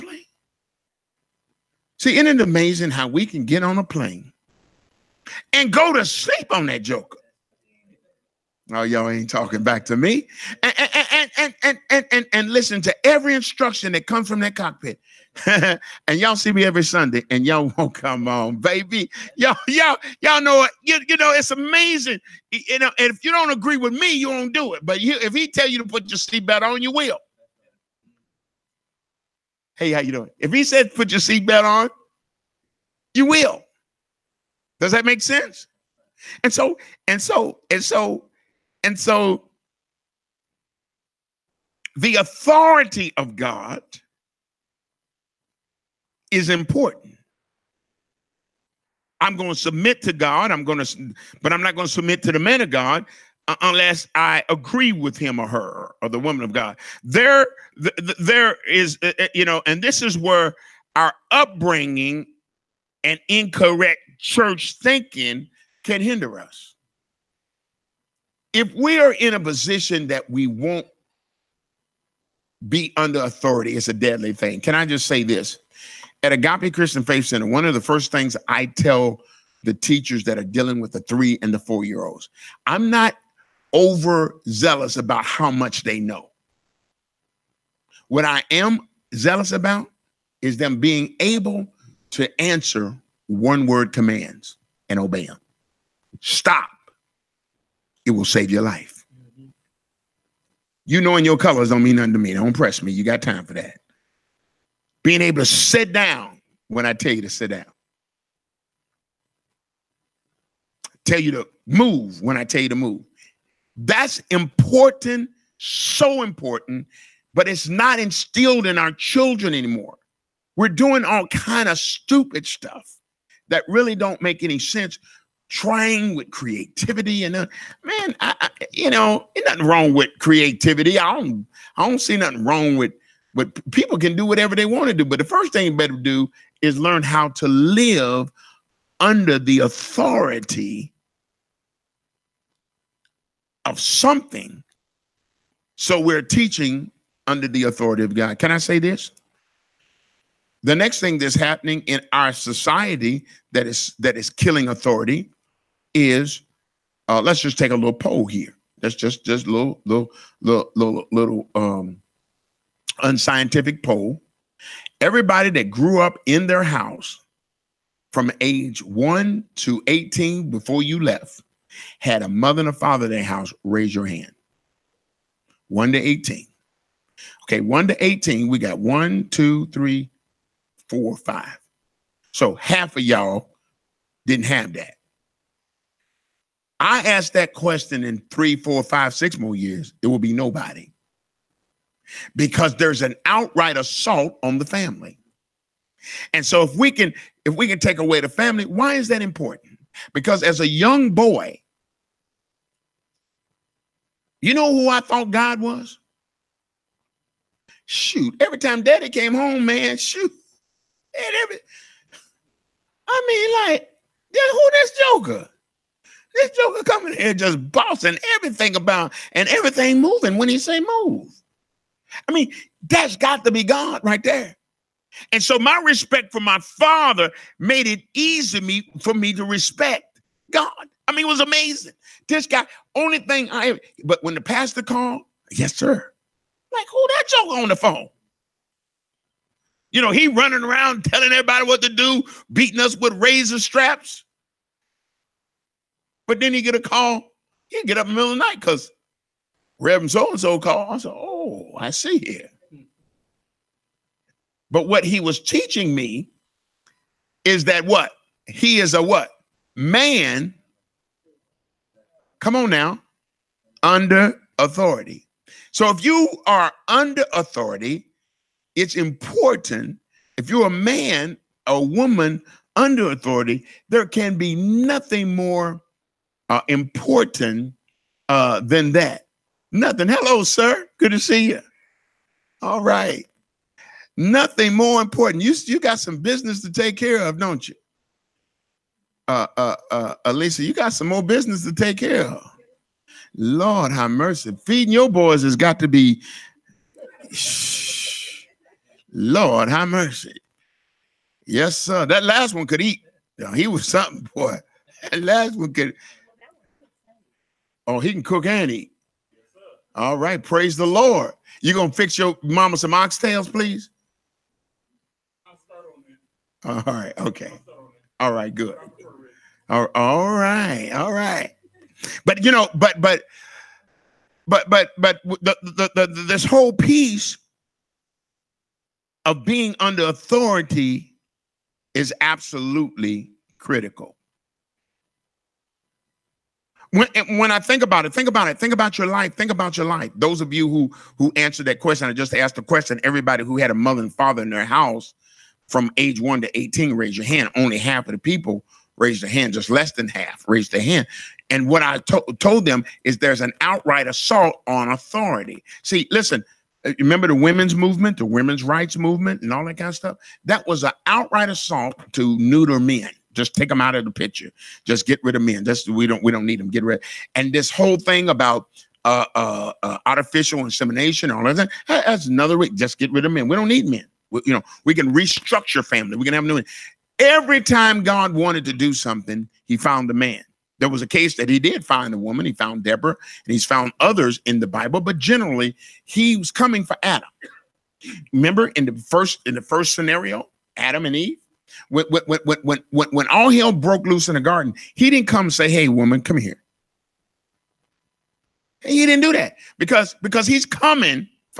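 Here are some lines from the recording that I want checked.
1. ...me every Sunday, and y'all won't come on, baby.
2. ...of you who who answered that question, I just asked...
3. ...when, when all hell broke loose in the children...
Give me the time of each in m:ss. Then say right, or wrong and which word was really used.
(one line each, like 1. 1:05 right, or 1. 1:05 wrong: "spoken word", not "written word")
1. 0:16 right
2. 5:40 right
3. 6:32 wrong: "garden", not "children".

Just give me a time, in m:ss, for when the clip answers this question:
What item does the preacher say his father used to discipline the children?
4:03.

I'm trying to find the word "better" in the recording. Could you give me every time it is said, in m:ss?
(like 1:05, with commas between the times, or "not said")
2:15.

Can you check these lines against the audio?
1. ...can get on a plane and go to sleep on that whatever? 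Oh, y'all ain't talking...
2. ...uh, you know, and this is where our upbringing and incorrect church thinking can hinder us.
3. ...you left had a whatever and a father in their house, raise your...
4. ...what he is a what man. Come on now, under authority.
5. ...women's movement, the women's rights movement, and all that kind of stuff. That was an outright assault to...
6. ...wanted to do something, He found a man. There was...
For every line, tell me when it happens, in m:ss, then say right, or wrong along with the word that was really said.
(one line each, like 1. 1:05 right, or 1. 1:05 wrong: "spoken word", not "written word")
1. 0:03 wrong: "joker", not "whatever"
2. 0:59 right
3. 2:50 wrong: "mother", not "whatever"
4. 4:17 right
5. 5:57 right
6. 6:18 right.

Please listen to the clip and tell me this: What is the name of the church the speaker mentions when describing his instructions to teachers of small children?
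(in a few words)
Agape Christian Faith Center.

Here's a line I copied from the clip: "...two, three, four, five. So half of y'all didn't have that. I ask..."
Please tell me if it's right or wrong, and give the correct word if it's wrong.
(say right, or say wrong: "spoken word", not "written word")
right.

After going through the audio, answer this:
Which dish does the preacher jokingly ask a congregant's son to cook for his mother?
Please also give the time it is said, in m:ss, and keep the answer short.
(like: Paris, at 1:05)
Oxtails, at 5:12.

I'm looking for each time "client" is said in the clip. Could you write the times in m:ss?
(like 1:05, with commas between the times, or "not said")
not said.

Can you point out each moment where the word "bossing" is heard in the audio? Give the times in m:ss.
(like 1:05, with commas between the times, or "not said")
3:37.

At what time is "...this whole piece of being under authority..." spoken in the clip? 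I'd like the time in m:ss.
5:26.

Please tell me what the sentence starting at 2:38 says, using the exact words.
That's just just little little little little, little um, unscientific poll.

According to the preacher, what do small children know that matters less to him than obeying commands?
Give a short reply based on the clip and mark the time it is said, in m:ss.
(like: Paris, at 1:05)
Colors, at 1:41.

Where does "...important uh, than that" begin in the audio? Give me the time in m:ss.
4:36.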